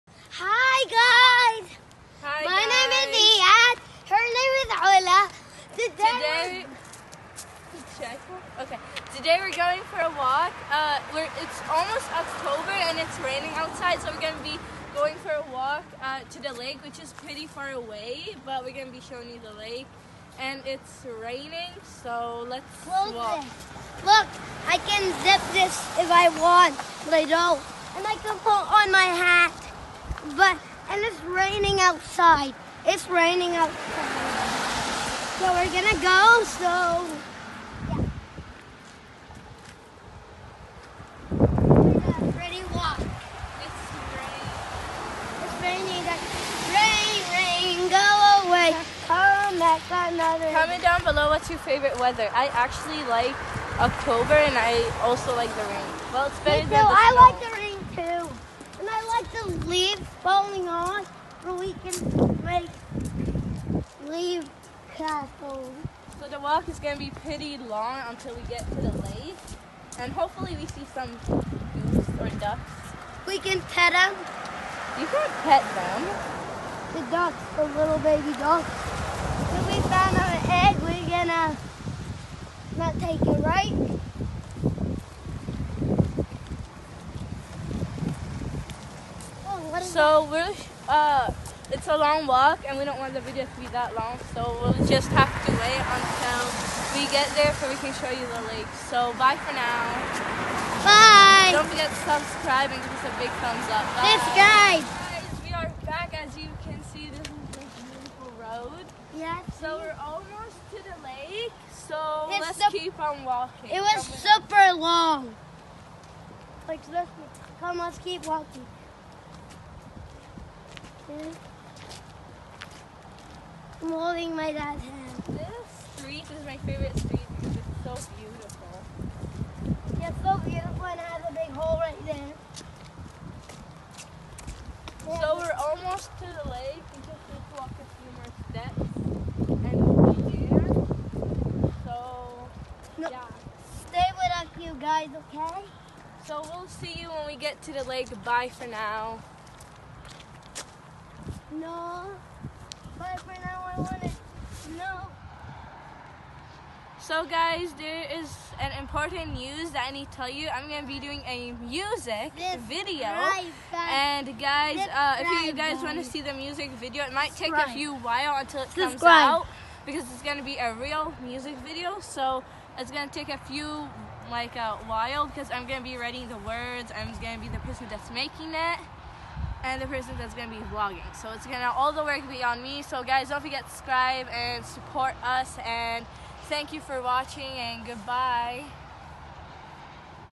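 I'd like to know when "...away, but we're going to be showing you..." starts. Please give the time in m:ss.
0:17.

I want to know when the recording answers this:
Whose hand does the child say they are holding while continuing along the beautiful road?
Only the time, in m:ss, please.
2:04.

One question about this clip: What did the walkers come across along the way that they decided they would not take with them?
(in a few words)
An egg.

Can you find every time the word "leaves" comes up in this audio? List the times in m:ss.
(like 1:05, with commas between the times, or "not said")
0:59, 1:04.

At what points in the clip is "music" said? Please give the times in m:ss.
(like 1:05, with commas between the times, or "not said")
2:41, 2:46, 2:51.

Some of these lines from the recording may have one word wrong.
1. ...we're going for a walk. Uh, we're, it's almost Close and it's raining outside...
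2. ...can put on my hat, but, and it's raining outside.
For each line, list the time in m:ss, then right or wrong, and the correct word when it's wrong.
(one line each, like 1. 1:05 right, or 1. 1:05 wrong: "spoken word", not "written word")
1. 0:09 wrong: "October", not "Close"
2. 0:28 right.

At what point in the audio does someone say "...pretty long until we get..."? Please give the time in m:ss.
1:07.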